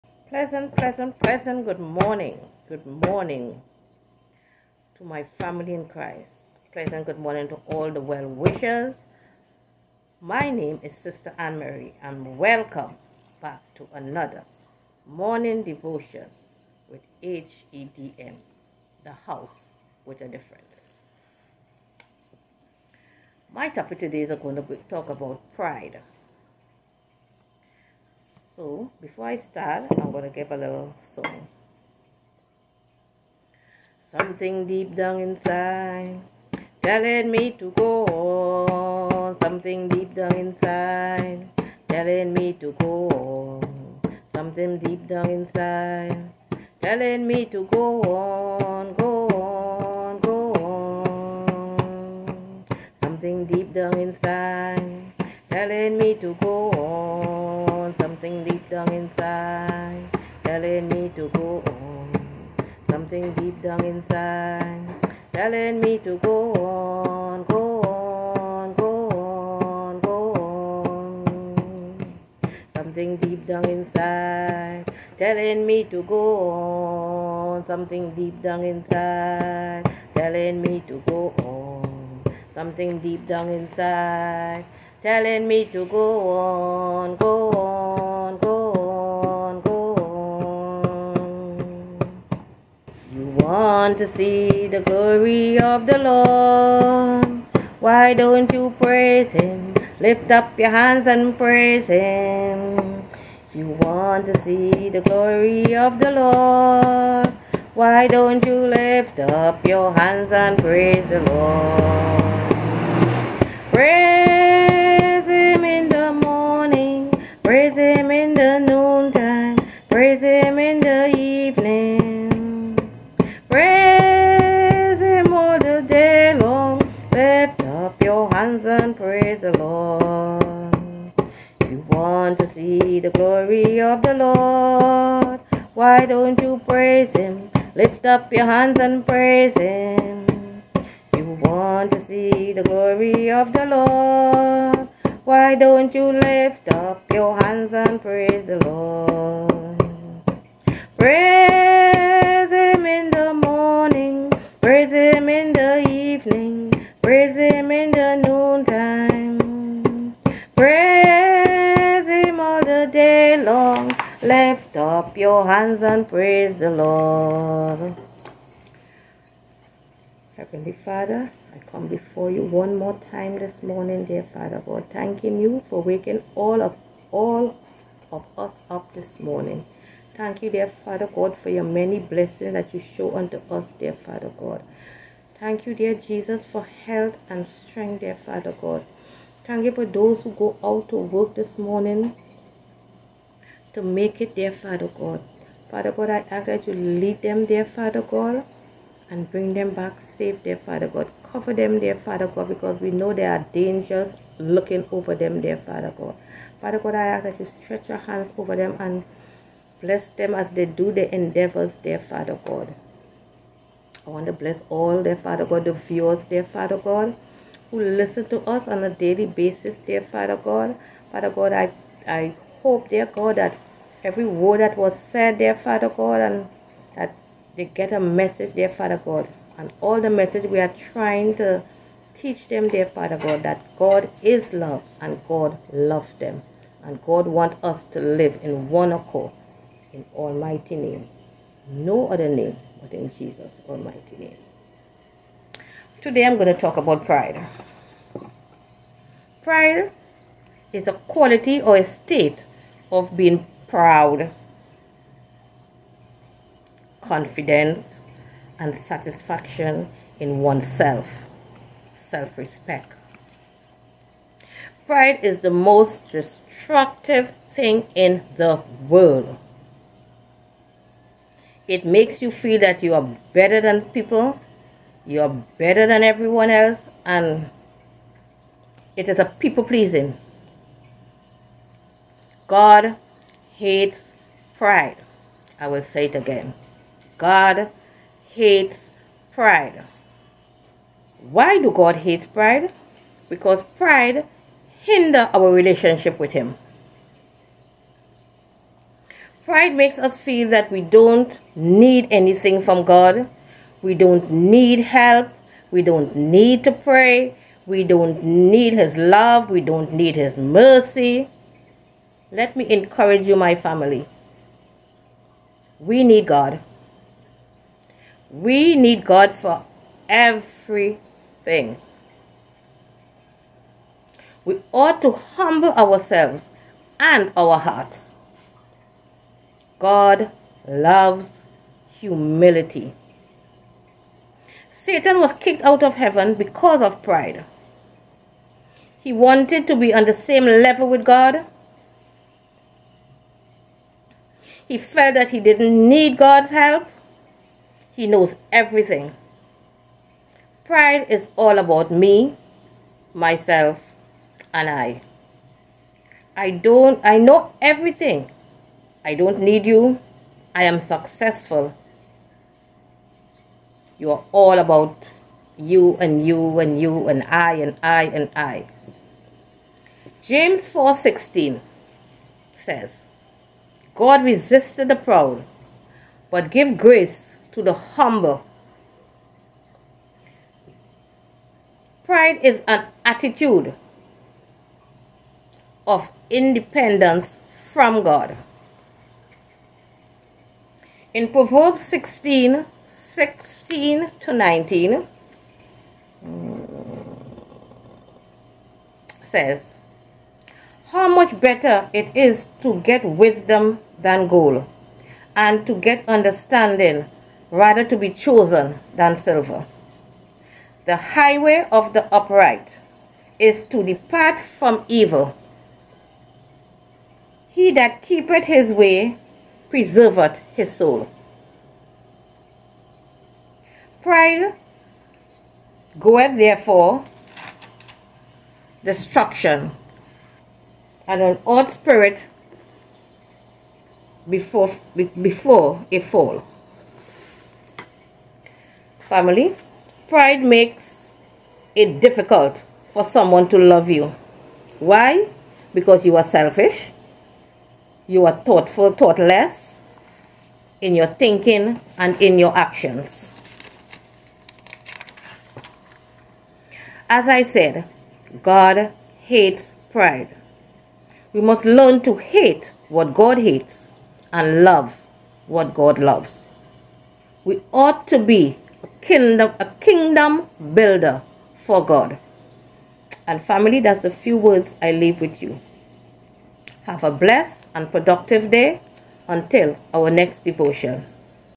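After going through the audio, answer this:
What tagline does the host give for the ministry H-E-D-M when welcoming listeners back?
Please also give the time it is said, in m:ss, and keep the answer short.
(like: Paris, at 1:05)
the house with a difference, at 0:19.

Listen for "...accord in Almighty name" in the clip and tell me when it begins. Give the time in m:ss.
3:58.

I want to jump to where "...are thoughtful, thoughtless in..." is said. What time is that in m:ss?
7:28.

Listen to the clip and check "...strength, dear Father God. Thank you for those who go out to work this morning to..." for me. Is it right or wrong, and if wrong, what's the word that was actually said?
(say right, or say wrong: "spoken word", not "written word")
right.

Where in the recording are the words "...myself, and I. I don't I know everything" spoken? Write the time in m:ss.
5:53.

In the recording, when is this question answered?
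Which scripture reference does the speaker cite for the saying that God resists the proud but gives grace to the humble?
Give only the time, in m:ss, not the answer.
6:10.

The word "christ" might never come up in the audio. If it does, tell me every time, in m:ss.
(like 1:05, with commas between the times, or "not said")
0:05.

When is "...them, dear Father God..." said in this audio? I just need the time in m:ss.
3:52.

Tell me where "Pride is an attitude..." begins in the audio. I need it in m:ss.
6:22.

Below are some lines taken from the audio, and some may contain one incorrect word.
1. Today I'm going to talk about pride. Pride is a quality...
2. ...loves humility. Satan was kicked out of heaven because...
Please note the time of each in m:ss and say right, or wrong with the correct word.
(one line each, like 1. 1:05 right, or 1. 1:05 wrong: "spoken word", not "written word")
1. 4:06 right
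2. 5:30 right.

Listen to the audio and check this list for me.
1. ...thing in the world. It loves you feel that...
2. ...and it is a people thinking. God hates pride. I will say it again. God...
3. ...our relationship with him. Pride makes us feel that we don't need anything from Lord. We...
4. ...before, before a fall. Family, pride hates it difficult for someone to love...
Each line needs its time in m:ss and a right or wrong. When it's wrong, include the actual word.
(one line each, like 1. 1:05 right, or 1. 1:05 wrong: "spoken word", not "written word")
1. 4:27 wrong: "makes", not "loves"
2. 4:37 wrong: "pleasing", not "thinking"
3. 4:55 wrong: "God", not "Lord"
4. 7:14 wrong: "makes", not "hates".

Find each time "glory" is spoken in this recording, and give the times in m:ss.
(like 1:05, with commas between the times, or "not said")
1:34, 1:45, 2:22.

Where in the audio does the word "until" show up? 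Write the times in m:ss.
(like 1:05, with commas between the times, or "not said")
7:59.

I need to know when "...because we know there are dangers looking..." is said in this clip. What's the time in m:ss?
3:22.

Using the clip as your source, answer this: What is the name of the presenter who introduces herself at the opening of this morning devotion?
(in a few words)
Sister Ann Marie.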